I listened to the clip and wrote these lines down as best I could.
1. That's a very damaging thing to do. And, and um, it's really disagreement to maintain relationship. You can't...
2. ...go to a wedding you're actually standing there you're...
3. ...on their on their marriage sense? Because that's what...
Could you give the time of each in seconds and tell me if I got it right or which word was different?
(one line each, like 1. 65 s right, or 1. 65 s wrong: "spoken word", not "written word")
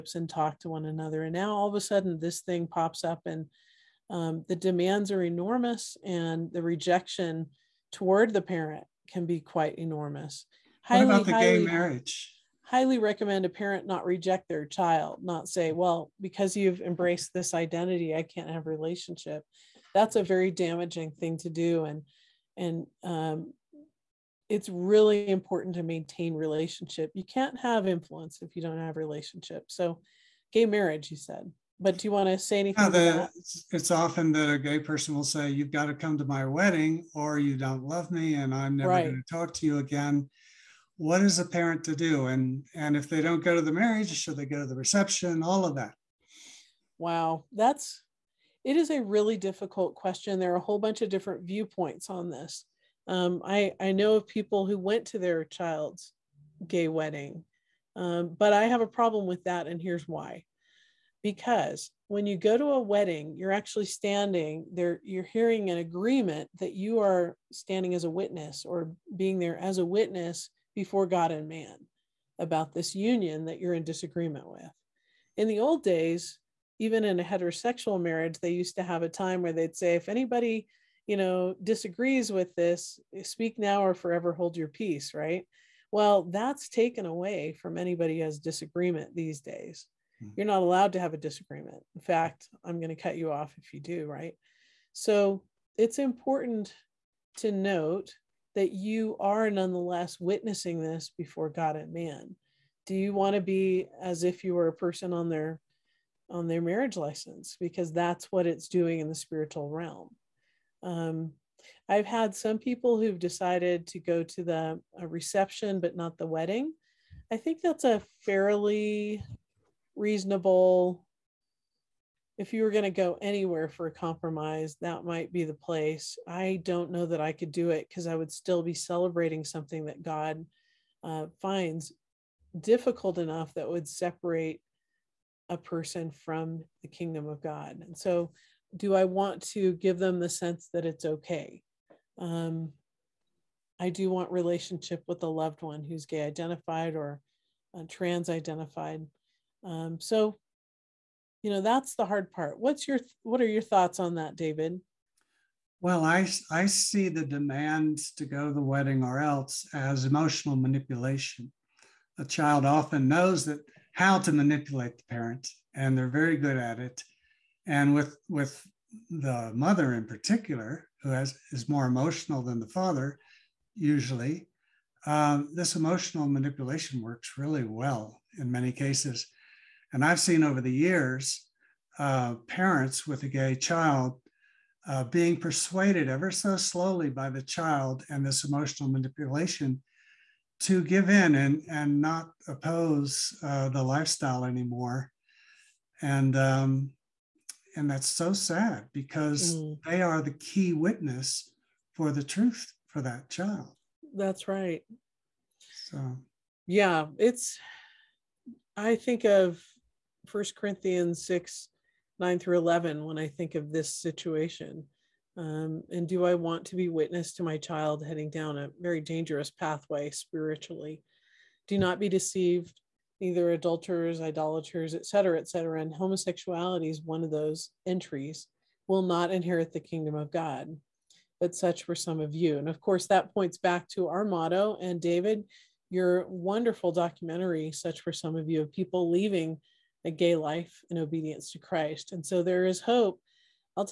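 1. 19 s wrong: "important", not "disagreement"
2. 62 s right
3. 105 s wrong: "license", not "sense".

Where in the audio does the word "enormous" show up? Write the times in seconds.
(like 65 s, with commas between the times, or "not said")
5 s, 9 s.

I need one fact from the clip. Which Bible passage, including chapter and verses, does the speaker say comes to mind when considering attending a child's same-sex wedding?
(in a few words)
1 Corinthians 6:9-11.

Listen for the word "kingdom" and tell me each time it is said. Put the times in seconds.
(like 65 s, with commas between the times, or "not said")
136 s, 229 s.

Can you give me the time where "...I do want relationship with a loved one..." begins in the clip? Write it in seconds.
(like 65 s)
143 s.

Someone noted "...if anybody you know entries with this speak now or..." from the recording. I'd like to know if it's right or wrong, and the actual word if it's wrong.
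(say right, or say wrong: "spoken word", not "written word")
wrong: "disagrees", not "entries".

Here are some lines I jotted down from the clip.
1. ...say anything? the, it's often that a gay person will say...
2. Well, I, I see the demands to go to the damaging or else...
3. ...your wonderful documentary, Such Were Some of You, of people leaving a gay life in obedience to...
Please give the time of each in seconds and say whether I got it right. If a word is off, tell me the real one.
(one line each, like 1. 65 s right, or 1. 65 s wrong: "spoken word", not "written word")
1. 32 s right
2. 155 s wrong: "wedding", not "damaging"
3. 235 s right.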